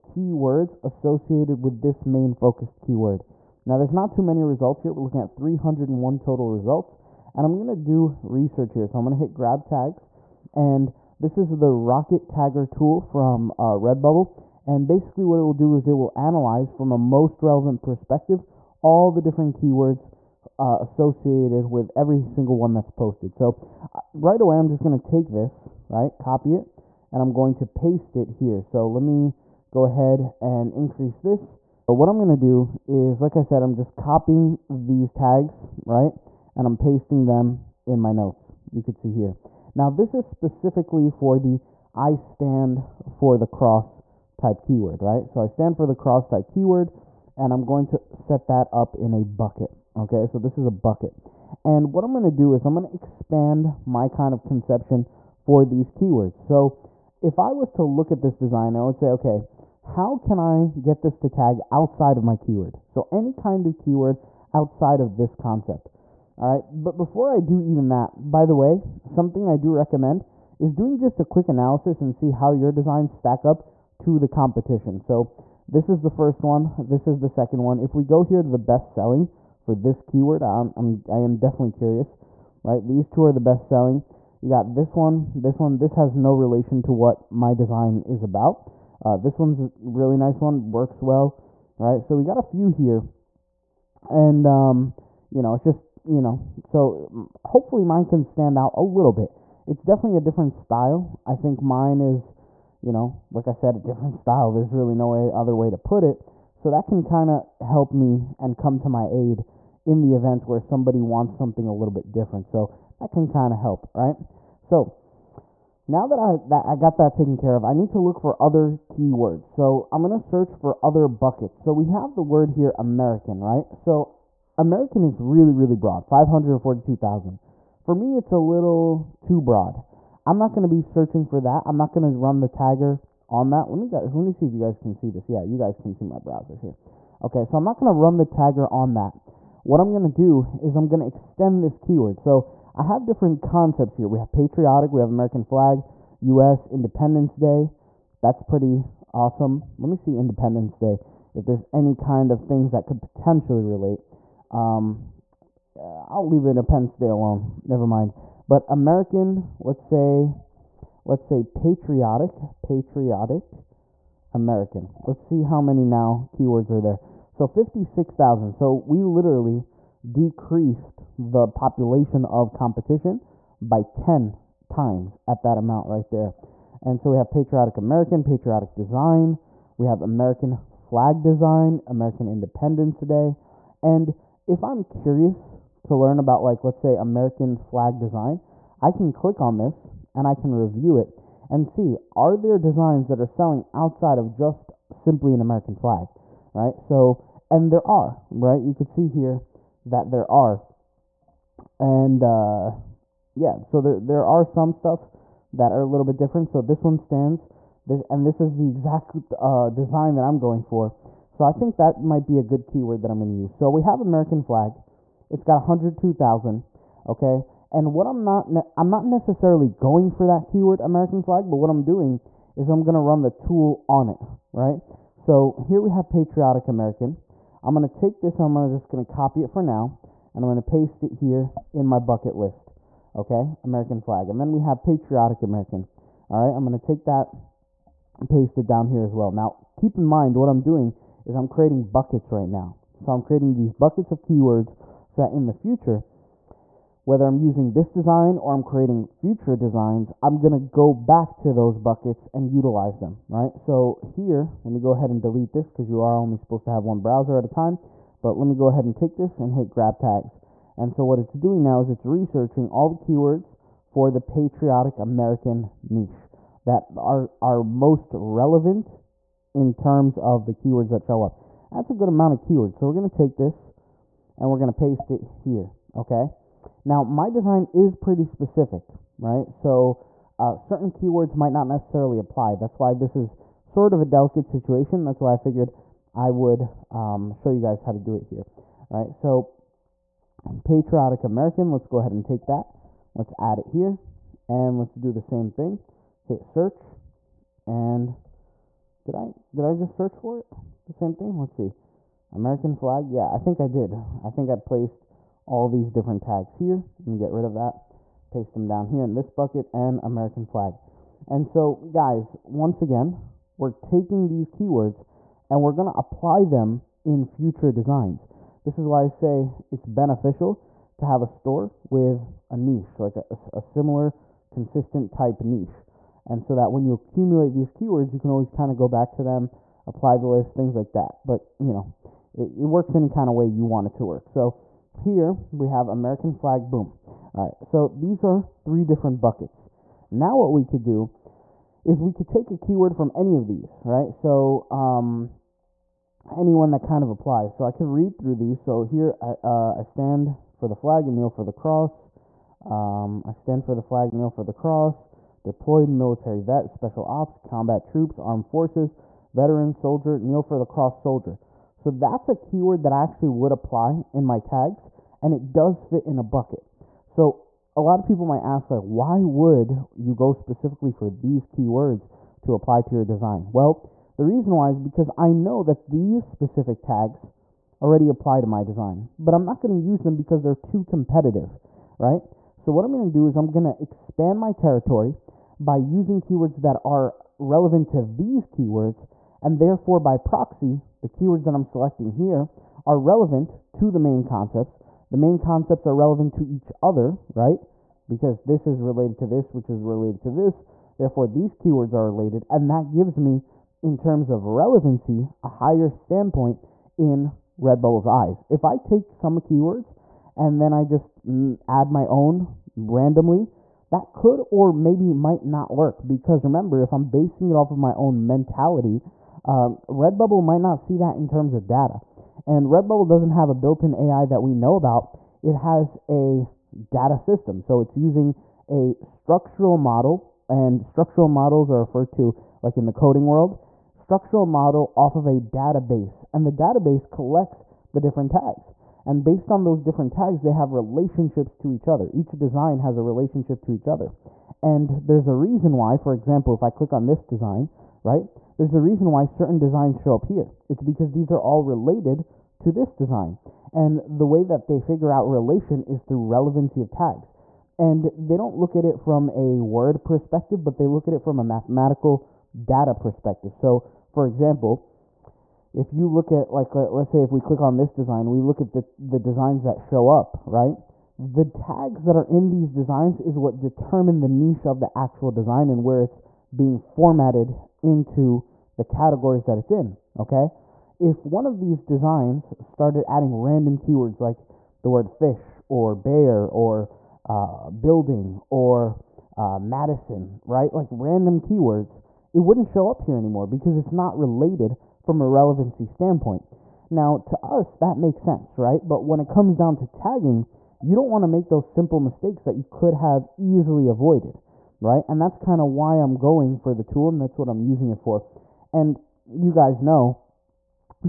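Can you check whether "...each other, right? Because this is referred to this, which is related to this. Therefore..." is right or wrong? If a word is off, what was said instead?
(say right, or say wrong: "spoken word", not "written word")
wrong: "related", not "referred".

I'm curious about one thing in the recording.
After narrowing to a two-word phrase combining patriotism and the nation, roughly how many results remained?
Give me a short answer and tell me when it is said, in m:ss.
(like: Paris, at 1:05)
56,000, at 2:47.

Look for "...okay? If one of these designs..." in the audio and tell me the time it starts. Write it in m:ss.
8:00.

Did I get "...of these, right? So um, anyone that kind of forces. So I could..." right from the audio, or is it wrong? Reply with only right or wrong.
wrong.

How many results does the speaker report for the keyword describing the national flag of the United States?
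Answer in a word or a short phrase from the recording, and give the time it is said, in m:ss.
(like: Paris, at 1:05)
102,000, at 3:35.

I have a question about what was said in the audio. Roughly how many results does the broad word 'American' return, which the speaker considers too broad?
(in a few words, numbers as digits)
542,000.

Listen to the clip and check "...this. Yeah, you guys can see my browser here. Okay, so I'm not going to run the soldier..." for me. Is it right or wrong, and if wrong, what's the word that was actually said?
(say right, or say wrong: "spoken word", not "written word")
wrong: "tagger", not "soldier".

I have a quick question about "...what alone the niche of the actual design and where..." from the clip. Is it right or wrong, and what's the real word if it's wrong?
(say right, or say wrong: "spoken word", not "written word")
wrong: "determine", not "alone".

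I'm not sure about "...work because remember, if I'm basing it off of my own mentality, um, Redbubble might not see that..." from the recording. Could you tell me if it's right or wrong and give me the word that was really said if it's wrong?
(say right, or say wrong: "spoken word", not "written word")
right.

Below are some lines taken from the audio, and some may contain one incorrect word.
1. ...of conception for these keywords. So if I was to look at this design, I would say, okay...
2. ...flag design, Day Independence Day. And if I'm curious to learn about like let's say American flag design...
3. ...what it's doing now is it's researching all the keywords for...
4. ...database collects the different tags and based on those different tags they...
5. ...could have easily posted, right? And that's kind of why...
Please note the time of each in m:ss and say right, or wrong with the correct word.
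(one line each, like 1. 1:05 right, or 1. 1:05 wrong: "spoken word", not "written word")
1. 0:54 right
2. 3:00 wrong: "American", not "Day"
3. 4:21 right
4. 7:16 right
5. 8:22 wrong: "avoided", not "posted".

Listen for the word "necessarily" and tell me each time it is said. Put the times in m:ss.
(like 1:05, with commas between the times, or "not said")
3:39, 4:41.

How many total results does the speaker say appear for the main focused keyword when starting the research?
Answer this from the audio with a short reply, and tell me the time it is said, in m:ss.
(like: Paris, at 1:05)
301, at 0:05.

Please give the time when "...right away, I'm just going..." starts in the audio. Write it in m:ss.
0:24.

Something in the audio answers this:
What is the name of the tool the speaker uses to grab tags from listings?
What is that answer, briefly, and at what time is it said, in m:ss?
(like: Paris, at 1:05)
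Rocket Tagger, at 0:11.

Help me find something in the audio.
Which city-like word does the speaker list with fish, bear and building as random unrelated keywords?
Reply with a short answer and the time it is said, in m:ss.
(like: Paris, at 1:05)
Madison, at 8:09.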